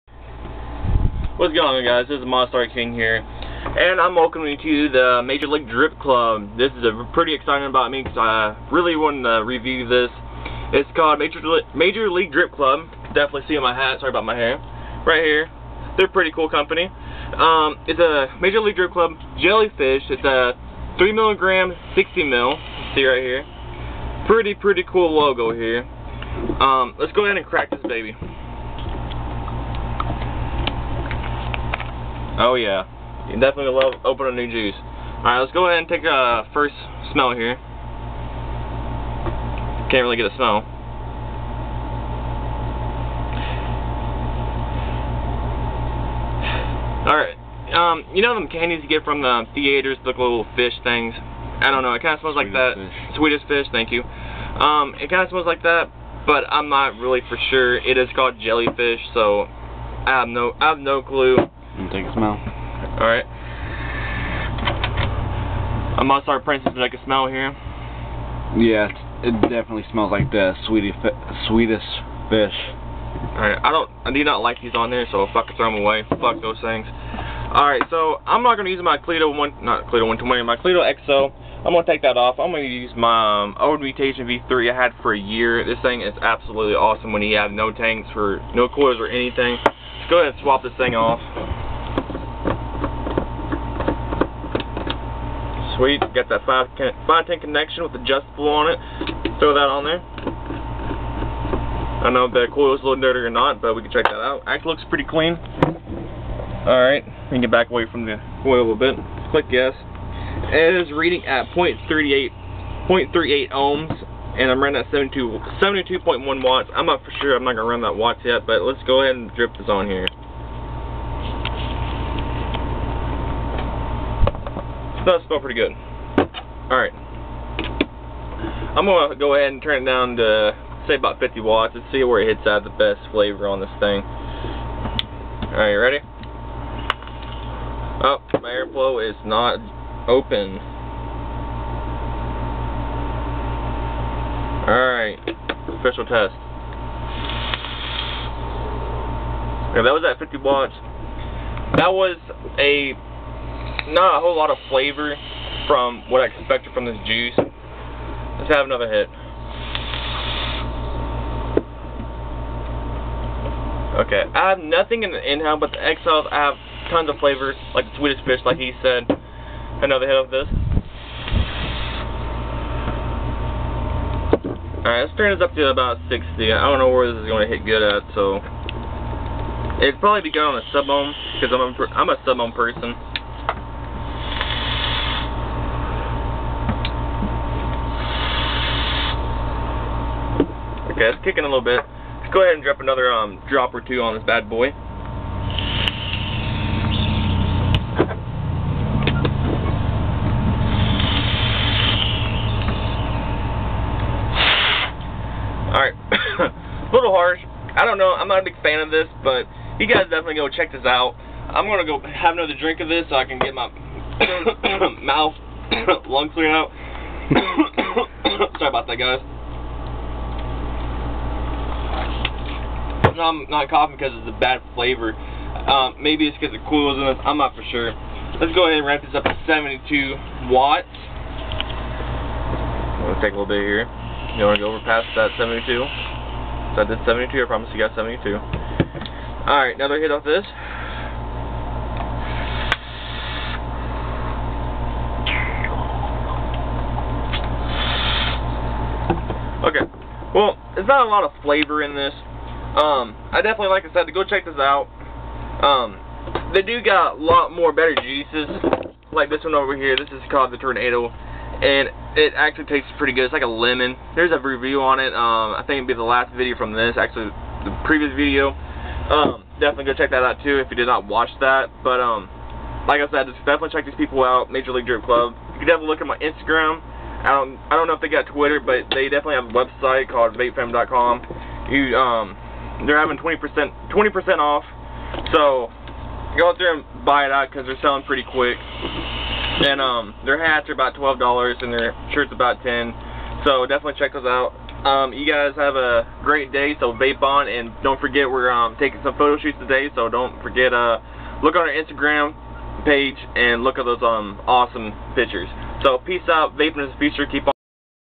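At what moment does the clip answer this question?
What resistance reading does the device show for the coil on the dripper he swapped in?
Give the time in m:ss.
1:52.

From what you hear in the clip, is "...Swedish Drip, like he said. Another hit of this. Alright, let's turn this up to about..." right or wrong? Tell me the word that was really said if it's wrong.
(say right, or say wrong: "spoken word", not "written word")
wrong: "Fish", not "Drip".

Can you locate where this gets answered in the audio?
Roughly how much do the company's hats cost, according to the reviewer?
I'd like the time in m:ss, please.
4:50.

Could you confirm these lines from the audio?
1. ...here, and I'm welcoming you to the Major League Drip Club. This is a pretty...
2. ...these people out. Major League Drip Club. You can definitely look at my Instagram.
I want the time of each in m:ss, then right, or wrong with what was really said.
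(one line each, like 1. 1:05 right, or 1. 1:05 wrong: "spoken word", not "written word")
1. 0:02 right
2. 4:33 right.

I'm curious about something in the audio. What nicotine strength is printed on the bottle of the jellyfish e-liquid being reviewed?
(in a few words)
3 milligram.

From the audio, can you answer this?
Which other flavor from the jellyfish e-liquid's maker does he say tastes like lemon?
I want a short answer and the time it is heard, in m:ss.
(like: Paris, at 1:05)
Tornado, at 4:20.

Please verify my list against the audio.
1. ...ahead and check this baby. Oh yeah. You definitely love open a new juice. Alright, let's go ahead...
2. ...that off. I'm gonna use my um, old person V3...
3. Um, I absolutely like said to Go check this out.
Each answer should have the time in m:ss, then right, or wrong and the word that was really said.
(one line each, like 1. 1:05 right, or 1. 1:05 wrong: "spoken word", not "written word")
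1. 0:27 wrong: "crack", not "check"
2. 1:22 wrong: "mutation", not "person"
3. 4:12 wrong: "definitely", not "absolutely".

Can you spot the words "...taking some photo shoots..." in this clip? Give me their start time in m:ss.
4:58.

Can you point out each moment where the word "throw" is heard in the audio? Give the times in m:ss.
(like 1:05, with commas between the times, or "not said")
1:15, 1:39.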